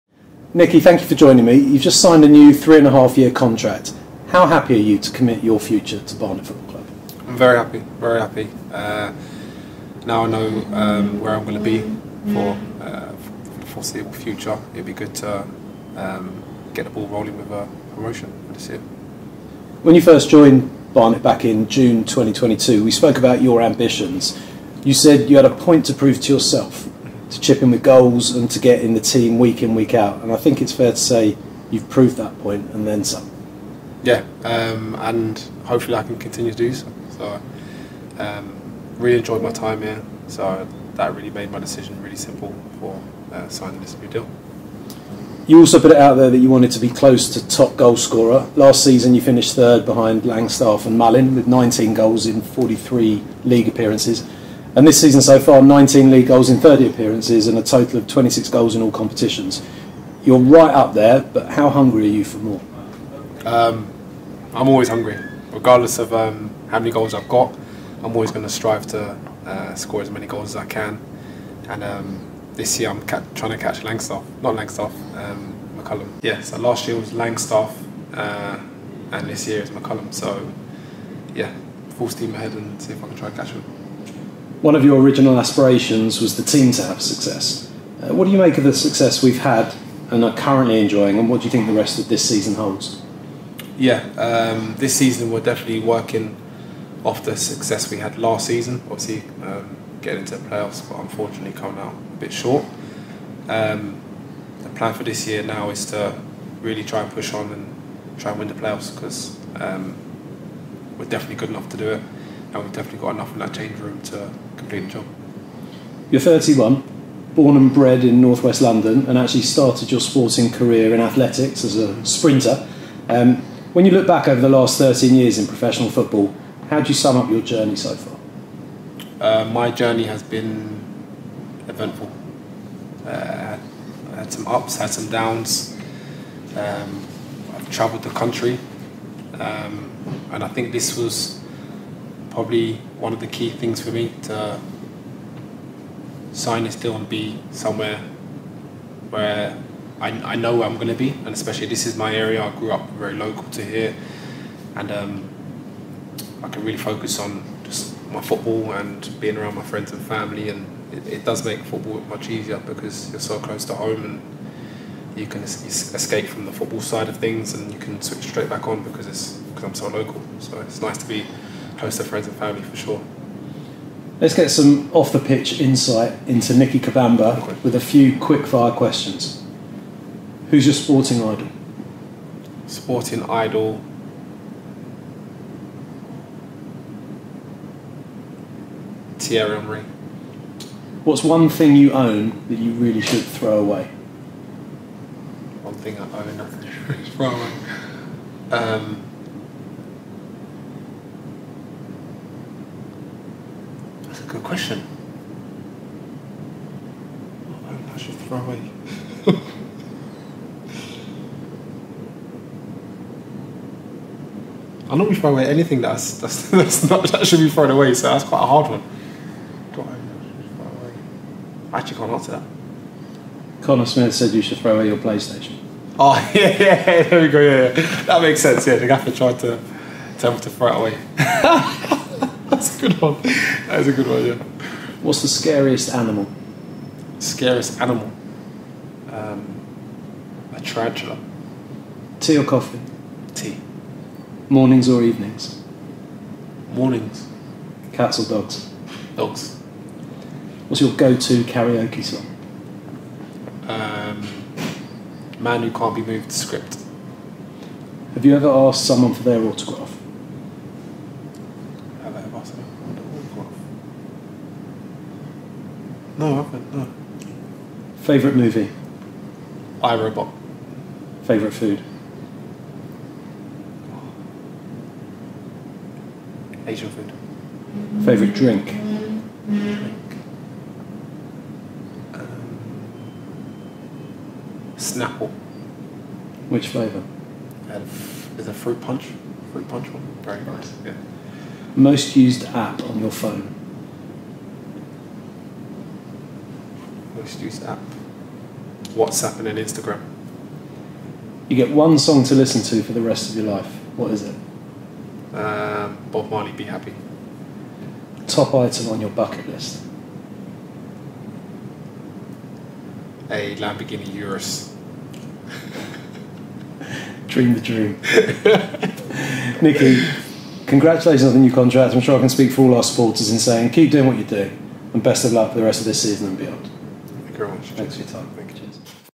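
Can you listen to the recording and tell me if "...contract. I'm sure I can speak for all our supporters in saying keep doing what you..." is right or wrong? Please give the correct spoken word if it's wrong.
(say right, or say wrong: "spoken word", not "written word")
right.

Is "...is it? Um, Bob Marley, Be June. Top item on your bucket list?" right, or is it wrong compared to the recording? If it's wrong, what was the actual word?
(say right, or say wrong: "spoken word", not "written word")
wrong: "Happy", not "June".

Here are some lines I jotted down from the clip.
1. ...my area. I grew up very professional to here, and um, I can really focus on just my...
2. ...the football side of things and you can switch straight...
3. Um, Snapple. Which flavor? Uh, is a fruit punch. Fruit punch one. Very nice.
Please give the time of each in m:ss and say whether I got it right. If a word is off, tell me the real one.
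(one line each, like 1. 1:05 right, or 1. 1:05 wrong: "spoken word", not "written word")
1. 2:31 wrong: "local", not "professional"
2. 2:46 right
3. 4:42 right.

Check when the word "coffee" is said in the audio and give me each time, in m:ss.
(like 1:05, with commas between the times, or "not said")
4:02.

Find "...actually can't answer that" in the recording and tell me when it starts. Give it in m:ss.
3:41.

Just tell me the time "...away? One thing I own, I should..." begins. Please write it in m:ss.
3:13.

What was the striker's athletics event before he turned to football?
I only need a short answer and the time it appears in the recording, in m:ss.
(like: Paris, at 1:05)
Sprinter, at 2:02.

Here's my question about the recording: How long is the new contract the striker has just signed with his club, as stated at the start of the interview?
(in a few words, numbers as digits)
3 and a half years.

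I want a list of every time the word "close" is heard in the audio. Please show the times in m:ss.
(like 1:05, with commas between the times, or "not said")
0:46, 2:43, 2:51.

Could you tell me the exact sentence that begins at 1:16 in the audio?
Yeah, so last year was Langstaff, uh, and this year is McCullum.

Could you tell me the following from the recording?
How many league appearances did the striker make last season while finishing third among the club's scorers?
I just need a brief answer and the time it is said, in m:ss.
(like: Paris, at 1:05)
43, at 0:52.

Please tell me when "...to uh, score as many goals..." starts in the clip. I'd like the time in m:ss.
1:08.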